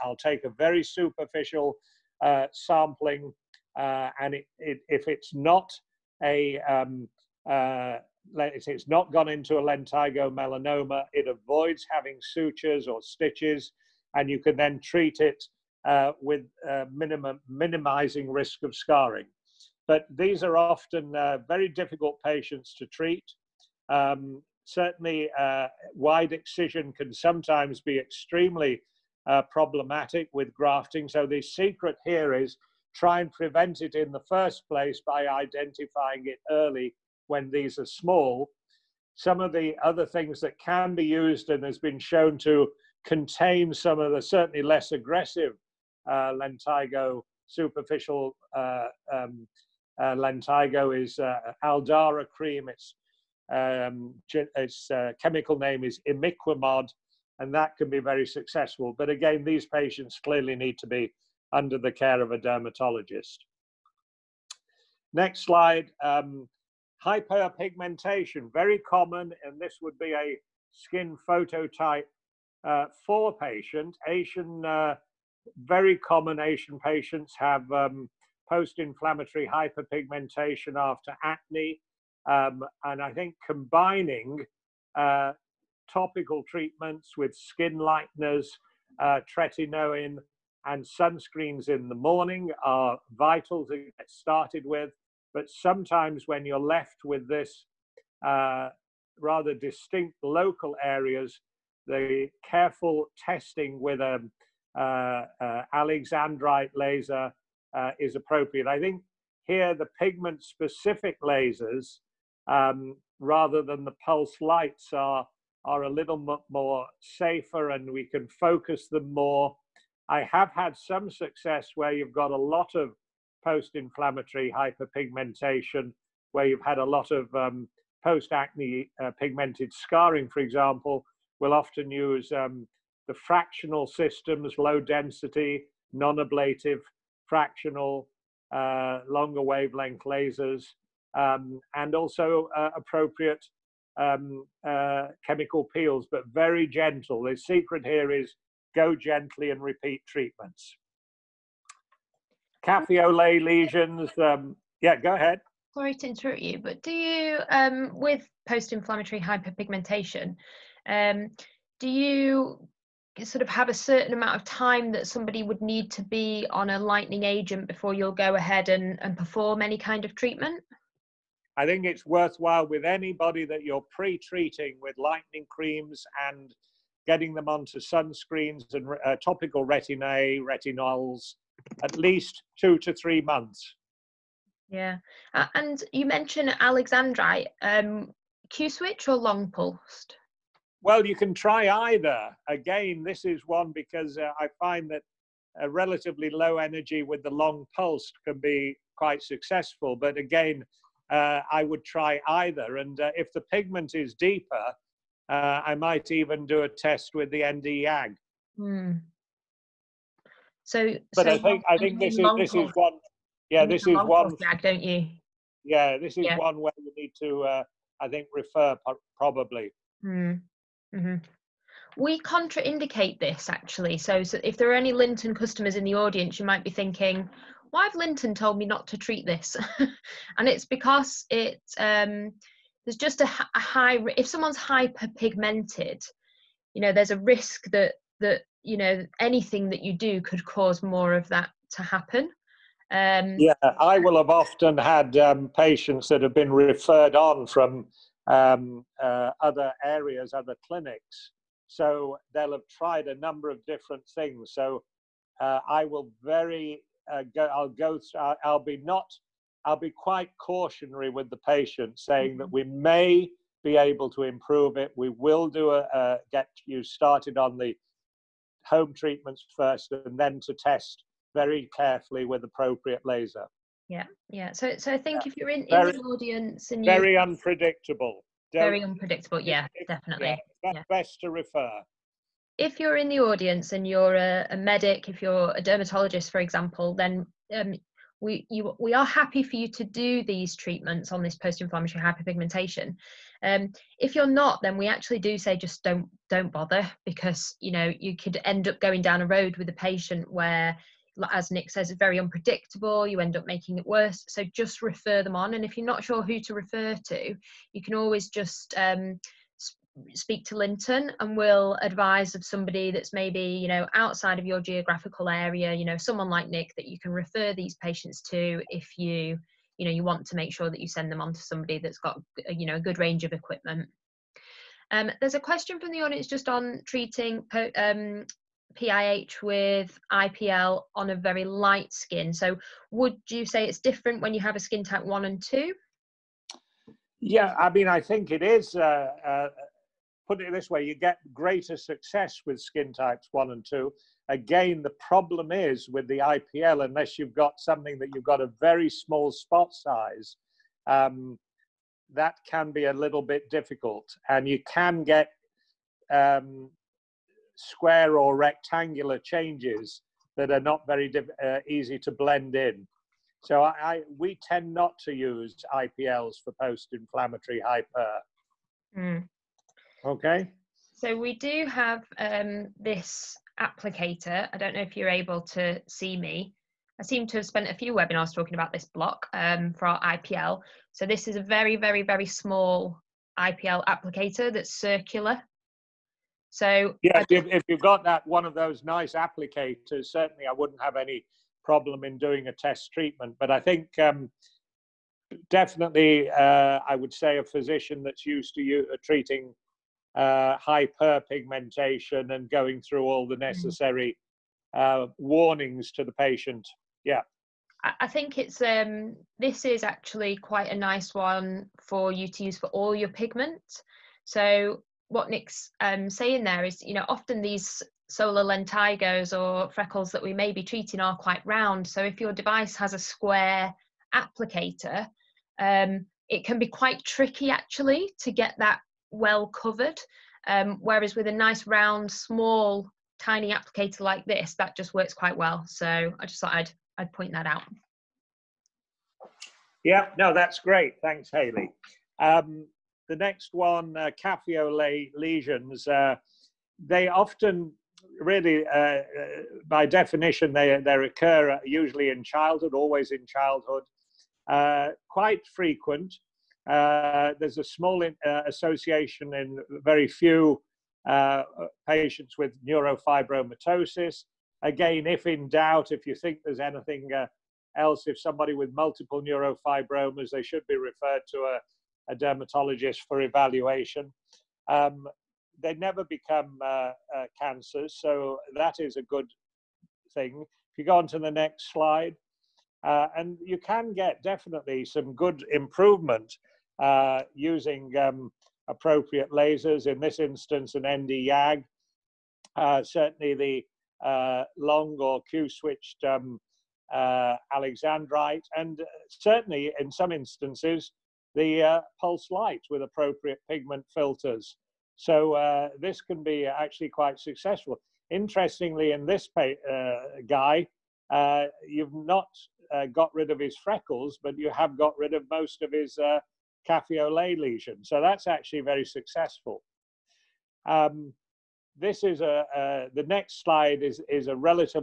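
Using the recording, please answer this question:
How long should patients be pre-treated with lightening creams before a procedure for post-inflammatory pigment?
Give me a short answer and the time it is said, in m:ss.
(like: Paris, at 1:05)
2 to 3 months, at 3:02.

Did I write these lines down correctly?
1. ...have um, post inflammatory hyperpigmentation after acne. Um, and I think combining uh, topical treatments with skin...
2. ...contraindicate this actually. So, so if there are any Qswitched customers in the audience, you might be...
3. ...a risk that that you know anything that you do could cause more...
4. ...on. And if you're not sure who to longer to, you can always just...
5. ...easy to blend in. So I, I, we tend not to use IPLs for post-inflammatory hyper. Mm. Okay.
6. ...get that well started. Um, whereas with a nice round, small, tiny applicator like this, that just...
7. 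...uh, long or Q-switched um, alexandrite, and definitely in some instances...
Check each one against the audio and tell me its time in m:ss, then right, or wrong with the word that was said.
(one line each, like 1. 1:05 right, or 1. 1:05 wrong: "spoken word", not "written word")
1. 1:17 right
2. 3:42 wrong: "Lynton", not "Qswitched"
3. 3:57 right
4. 5:05 wrong: "refer", not "longer"
5. 6:01 right
6. 7:08 wrong: "covered", not "started"
7. 8:14 wrong: "certainly", not "definitely".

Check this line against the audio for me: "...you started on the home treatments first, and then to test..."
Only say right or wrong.
right.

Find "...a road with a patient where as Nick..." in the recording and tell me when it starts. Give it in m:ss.
4:59.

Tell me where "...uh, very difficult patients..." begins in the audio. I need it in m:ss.
0:21.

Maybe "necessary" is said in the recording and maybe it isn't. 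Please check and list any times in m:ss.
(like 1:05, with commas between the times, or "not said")
6:43.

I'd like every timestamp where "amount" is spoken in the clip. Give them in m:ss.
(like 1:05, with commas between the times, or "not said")
2:44.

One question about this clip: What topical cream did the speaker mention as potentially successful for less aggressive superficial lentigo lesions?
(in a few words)
Aldara.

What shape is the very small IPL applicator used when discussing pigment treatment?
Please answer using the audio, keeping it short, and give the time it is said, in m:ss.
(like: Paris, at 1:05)
circular, at 6:24.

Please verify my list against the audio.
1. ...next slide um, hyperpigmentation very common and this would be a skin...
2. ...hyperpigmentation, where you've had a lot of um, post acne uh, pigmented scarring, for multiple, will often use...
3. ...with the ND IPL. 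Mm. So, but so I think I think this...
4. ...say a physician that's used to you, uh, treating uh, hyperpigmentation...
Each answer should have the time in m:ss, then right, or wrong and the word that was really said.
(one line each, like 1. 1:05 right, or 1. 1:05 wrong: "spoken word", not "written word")
1. 1:05 right
2. 2:04 wrong: "example", not "multiple"
3. 3:27 wrong: "YAG", not "IPL"
4. 6:37 right.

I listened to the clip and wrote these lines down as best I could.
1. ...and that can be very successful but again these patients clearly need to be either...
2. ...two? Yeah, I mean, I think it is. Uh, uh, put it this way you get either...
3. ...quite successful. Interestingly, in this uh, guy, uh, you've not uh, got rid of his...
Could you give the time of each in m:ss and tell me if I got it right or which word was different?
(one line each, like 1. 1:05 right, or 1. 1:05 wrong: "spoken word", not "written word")
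1. 0:57 wrong: "under", not "either"
2. 5:35 wrong: "greater", not "either"
3. 8:26 right.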